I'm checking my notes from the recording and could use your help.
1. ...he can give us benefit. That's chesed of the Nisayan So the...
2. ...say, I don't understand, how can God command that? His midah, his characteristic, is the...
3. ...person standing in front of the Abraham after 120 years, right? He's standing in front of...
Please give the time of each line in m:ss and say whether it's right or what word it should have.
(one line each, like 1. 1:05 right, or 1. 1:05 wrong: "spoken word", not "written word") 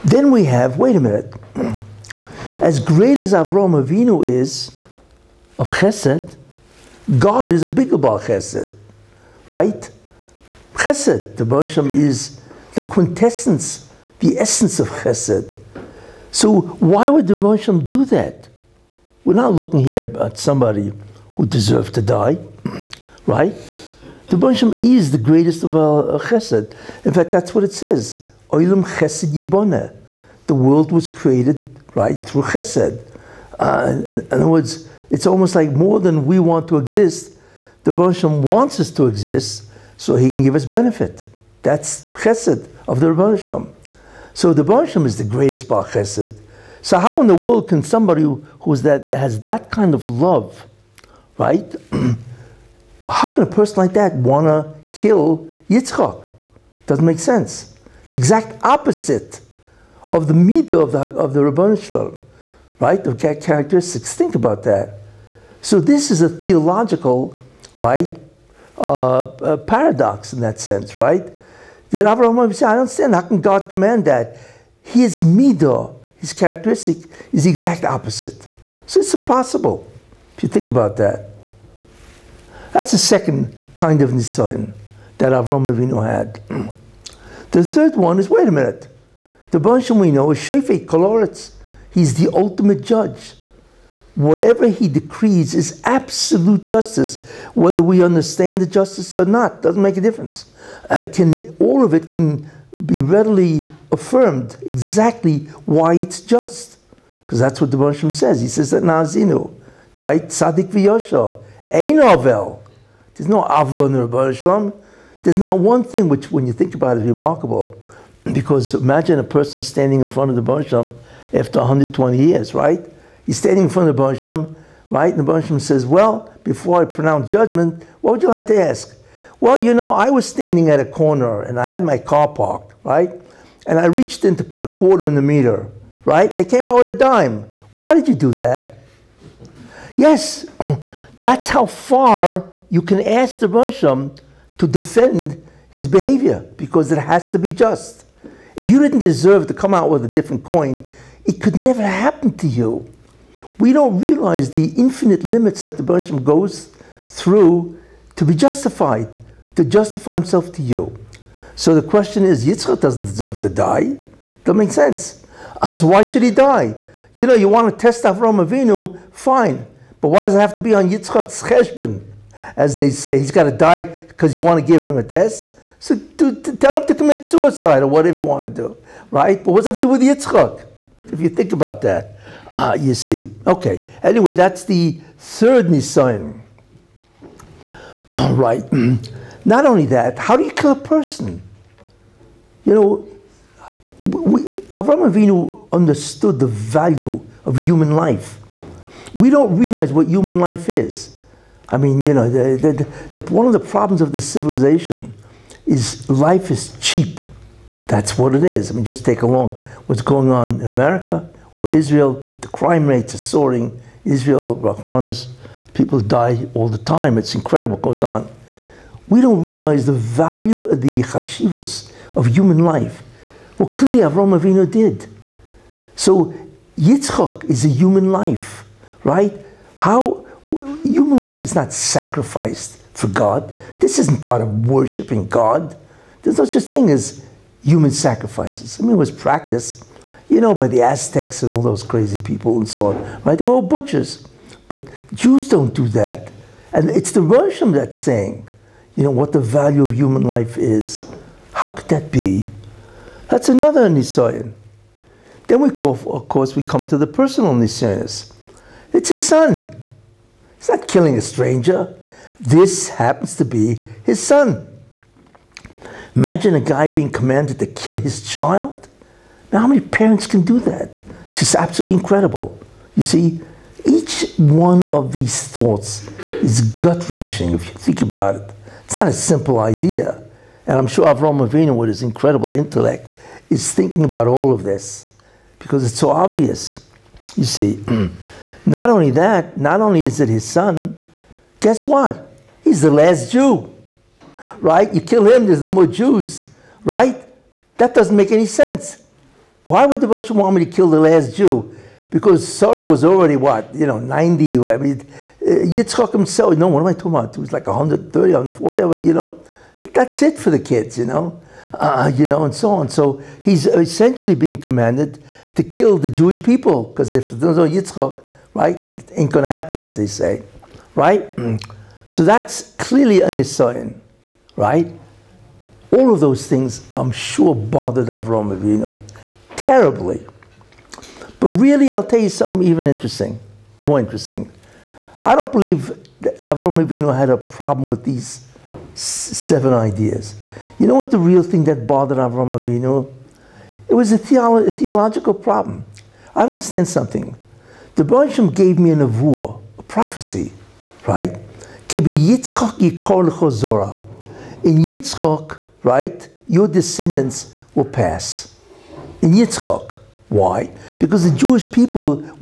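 1. 0:40 wrong: "Rebbeinu", not "Nisayan"
2. 1:12 right
3. 1:59 wrong: "Roshim", not "Abraham".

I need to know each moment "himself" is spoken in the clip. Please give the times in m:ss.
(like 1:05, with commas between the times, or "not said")
2:40, 5:06.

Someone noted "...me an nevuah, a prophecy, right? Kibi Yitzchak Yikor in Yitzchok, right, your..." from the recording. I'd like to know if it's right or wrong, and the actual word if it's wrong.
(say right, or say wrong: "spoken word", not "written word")
right.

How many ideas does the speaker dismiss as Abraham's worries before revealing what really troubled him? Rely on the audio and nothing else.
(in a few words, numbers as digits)
7.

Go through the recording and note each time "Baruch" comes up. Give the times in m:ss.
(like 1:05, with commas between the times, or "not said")
0:11, 0:17, 0:24.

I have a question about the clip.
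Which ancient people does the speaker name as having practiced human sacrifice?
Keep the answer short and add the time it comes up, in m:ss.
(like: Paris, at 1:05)
the Aztecs, at 4:00.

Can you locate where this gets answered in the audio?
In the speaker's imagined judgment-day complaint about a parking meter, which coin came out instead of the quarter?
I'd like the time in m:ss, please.
2:16.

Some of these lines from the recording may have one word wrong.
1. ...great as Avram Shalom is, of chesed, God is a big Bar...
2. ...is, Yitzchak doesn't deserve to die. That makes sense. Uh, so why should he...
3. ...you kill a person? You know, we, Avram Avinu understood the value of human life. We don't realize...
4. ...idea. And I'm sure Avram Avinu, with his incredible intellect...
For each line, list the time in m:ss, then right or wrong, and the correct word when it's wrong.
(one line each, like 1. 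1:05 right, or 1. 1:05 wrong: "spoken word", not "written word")
1. 0:02 wrong: "Avinu", not "Shalom"
2. 2:42 right
3. 3:10 right
4. 4:39 right.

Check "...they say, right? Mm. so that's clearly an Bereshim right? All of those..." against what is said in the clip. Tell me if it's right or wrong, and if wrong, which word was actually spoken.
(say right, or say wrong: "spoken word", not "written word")
wrong: "Nisayan", not "Bereshim".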